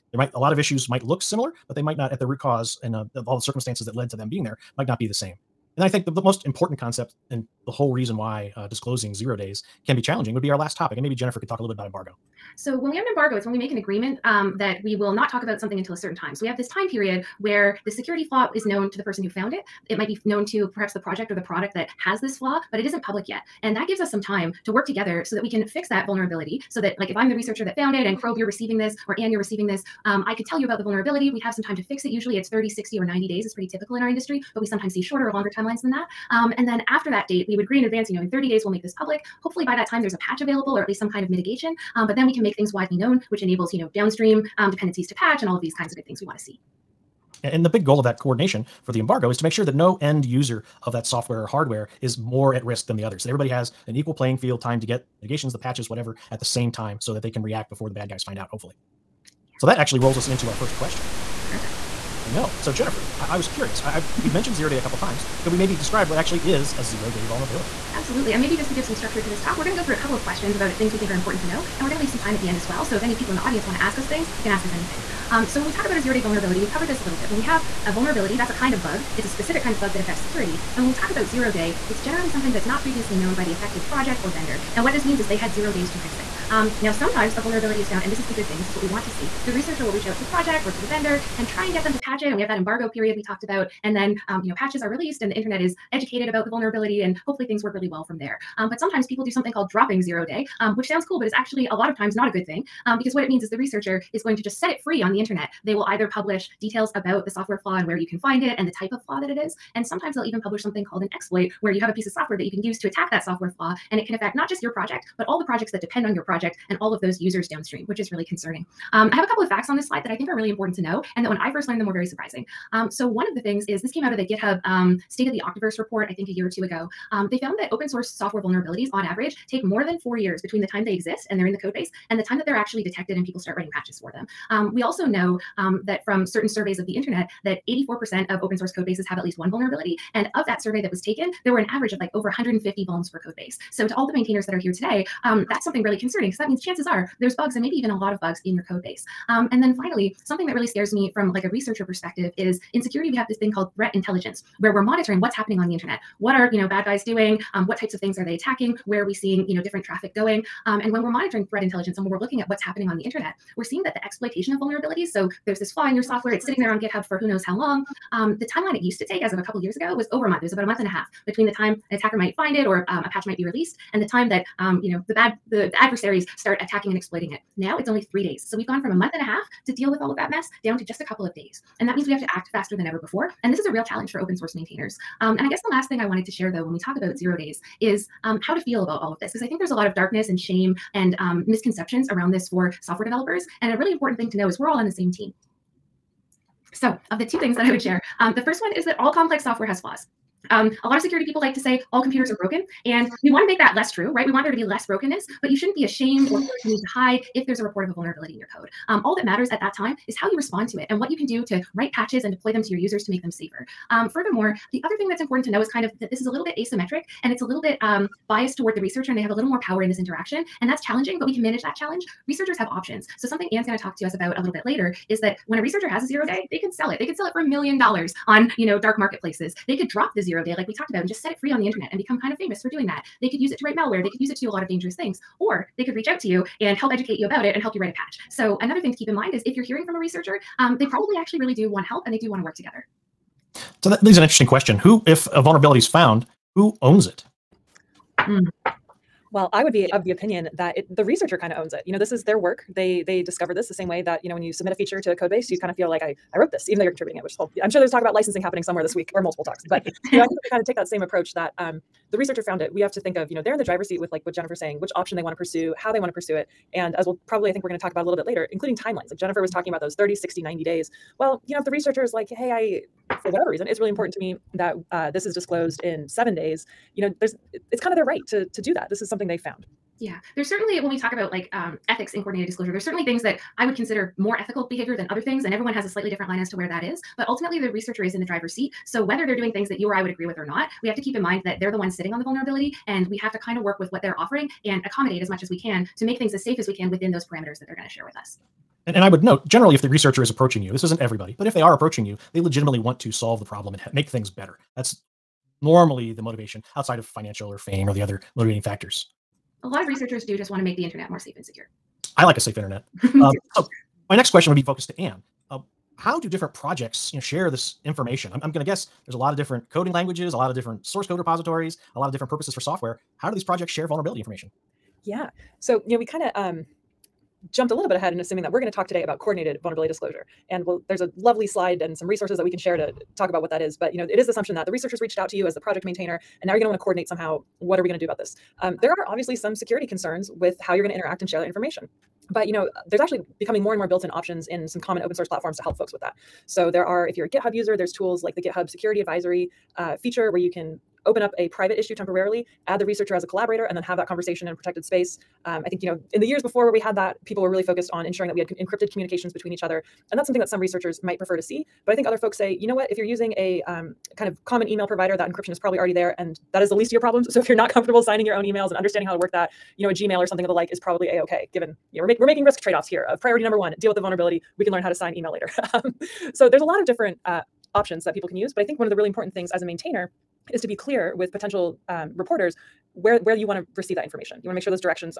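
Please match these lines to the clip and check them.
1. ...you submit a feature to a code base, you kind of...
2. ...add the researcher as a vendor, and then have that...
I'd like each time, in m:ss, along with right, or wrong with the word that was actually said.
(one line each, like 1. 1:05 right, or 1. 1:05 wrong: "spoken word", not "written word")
1. 4:14 right
2. 5:52 wrong: "collaborator", not "vendor".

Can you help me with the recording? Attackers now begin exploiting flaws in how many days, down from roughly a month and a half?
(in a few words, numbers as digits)
3 days.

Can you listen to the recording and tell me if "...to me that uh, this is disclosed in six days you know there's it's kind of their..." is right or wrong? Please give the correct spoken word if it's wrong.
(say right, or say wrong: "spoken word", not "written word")
wrong: "seven", not "six".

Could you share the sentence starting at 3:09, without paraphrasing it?
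Because I think there's a lot of darkness and shame and um, misconceptions around this for software developers.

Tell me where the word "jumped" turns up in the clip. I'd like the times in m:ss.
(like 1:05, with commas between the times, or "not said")
5:27.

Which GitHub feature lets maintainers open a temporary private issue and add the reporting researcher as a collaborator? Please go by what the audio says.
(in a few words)
GitHub Security Advisory.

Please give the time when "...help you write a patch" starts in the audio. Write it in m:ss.
3:57.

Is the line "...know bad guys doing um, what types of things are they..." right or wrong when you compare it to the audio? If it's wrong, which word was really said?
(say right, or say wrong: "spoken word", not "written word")
right.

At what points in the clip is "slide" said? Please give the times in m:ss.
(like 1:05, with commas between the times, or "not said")
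1:59, 5:31.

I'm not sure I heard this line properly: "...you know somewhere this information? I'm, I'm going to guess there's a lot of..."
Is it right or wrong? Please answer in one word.
wrong.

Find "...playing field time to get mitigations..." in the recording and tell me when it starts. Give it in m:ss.
0:54.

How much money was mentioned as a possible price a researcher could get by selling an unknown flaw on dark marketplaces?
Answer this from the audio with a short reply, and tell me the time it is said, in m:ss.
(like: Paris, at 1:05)
a million dollars, at 3:47.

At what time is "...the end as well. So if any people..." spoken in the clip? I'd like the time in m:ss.
1:12.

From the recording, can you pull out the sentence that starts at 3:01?
And that means we have to act faster than ever before.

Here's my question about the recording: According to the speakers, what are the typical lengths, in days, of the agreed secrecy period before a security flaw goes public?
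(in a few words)
30, 60, or 90 days.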